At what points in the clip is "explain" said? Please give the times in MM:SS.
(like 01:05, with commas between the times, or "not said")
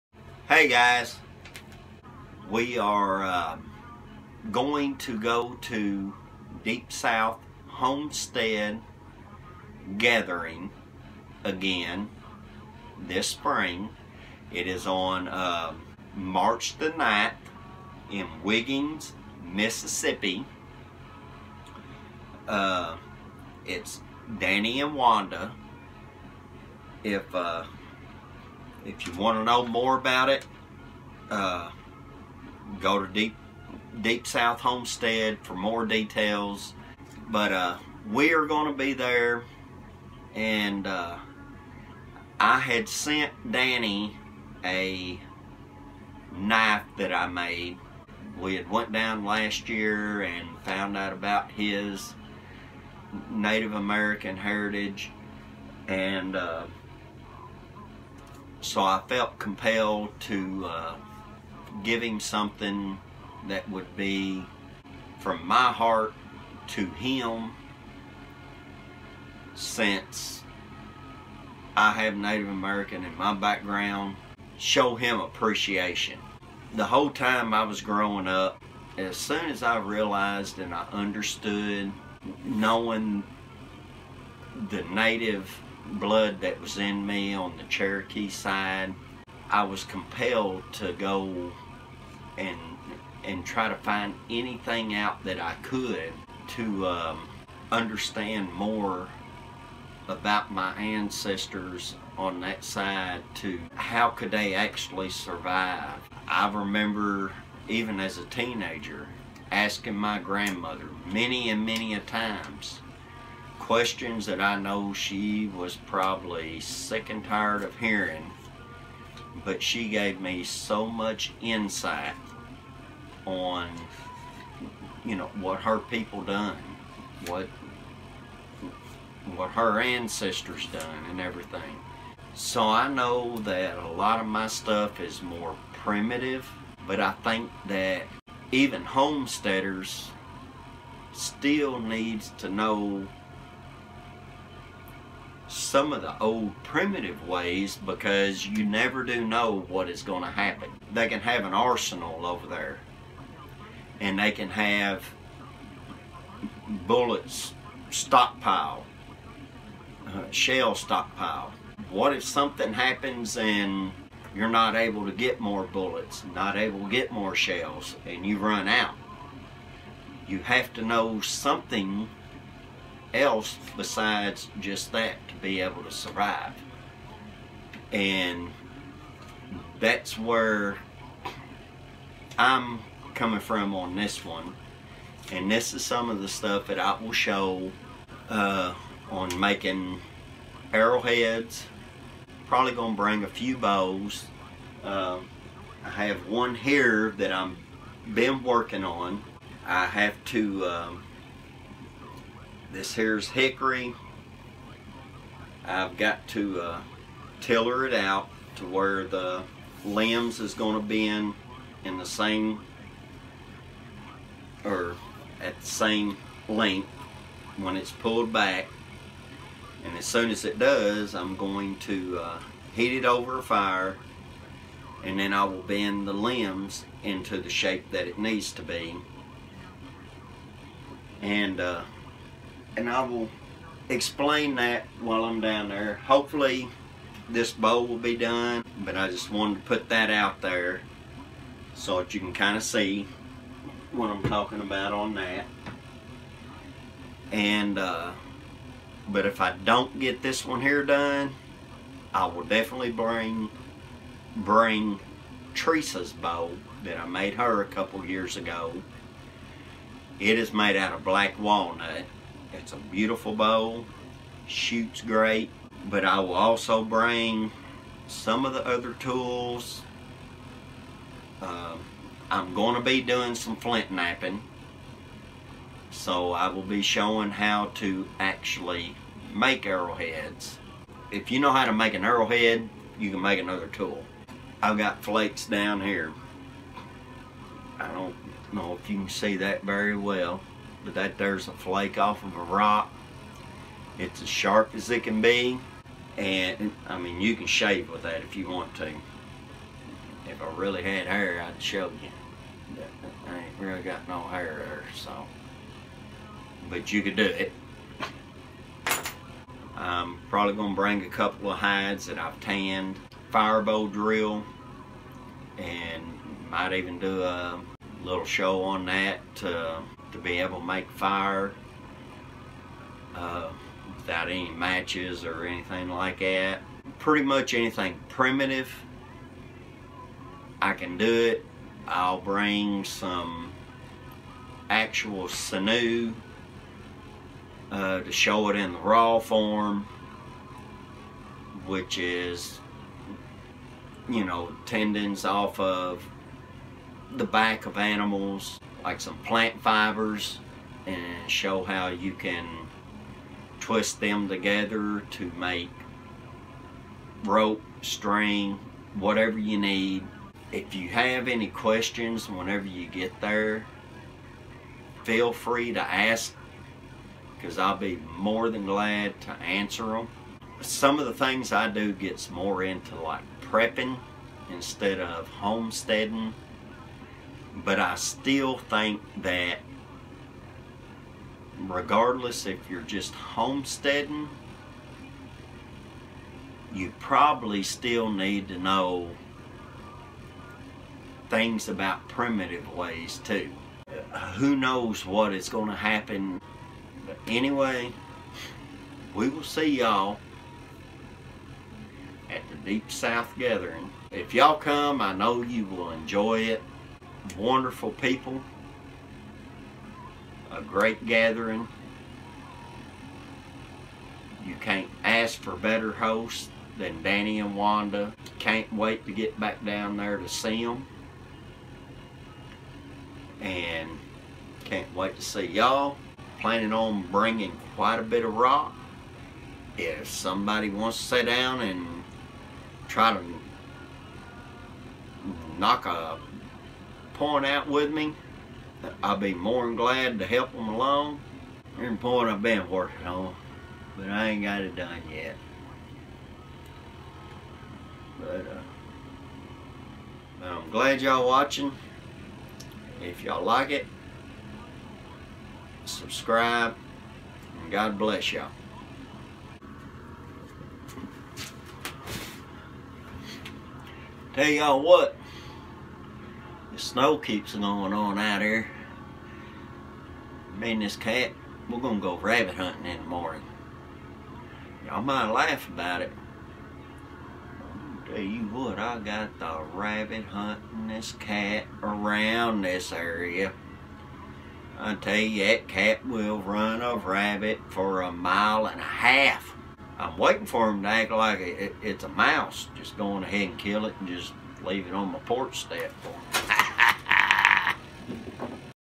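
03:53.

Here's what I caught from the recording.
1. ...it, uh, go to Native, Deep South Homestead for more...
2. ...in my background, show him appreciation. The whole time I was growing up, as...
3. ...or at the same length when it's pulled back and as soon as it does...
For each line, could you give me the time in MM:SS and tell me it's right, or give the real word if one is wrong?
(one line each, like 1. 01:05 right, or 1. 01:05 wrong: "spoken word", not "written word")
1. 00:30 wrong: "Deep", not "Native"
2. 01:13 right
3. 03:34 right.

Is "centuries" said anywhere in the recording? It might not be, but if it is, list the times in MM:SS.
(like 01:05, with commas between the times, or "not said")
not said.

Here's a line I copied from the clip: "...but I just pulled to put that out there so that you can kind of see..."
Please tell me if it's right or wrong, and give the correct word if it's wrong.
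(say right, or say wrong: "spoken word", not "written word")
wrong: "wanted", not "pulled".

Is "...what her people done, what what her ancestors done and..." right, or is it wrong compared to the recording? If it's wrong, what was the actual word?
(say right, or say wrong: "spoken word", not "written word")
right.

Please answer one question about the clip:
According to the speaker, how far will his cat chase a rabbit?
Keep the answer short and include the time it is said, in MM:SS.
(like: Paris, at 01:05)
A mile and a half, at 08:08.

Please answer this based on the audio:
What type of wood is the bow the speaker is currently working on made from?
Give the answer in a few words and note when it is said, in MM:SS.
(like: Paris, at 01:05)
Hickory, at 03:23.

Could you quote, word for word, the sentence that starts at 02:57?
And that's where I'm coming from on this one.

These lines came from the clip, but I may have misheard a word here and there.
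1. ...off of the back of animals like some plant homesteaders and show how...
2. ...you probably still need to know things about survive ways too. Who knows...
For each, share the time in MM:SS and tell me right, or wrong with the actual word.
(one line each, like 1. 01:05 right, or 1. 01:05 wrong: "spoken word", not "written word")
1. 05:45 wrong: "fibers", not "homesteaders"
2. 06:26 wrong: "primitive", not "survive".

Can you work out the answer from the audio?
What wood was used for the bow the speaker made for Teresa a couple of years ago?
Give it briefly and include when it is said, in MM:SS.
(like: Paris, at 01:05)
Black walnut, at 04:21.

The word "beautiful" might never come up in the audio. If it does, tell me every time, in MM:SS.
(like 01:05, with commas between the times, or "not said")
04:22.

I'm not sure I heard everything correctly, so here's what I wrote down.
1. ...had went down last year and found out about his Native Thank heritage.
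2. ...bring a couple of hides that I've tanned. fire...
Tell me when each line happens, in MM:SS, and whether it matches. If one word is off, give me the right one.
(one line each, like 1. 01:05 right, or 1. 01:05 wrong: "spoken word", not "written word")
1. 00:48 wrong: "American", not "Thank"
2. 05:10 right.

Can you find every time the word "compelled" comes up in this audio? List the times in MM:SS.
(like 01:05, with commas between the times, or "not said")
00:59, 01:29.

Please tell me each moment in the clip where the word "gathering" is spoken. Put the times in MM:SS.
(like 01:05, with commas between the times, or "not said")
00:09, 06:43, 06:51.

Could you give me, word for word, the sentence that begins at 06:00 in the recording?
If you have any questions whenever you get there, feel free to ask because I'll be more than glad to answer them.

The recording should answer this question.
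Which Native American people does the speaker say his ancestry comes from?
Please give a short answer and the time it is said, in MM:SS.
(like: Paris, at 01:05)
Cherokee, at 01:27.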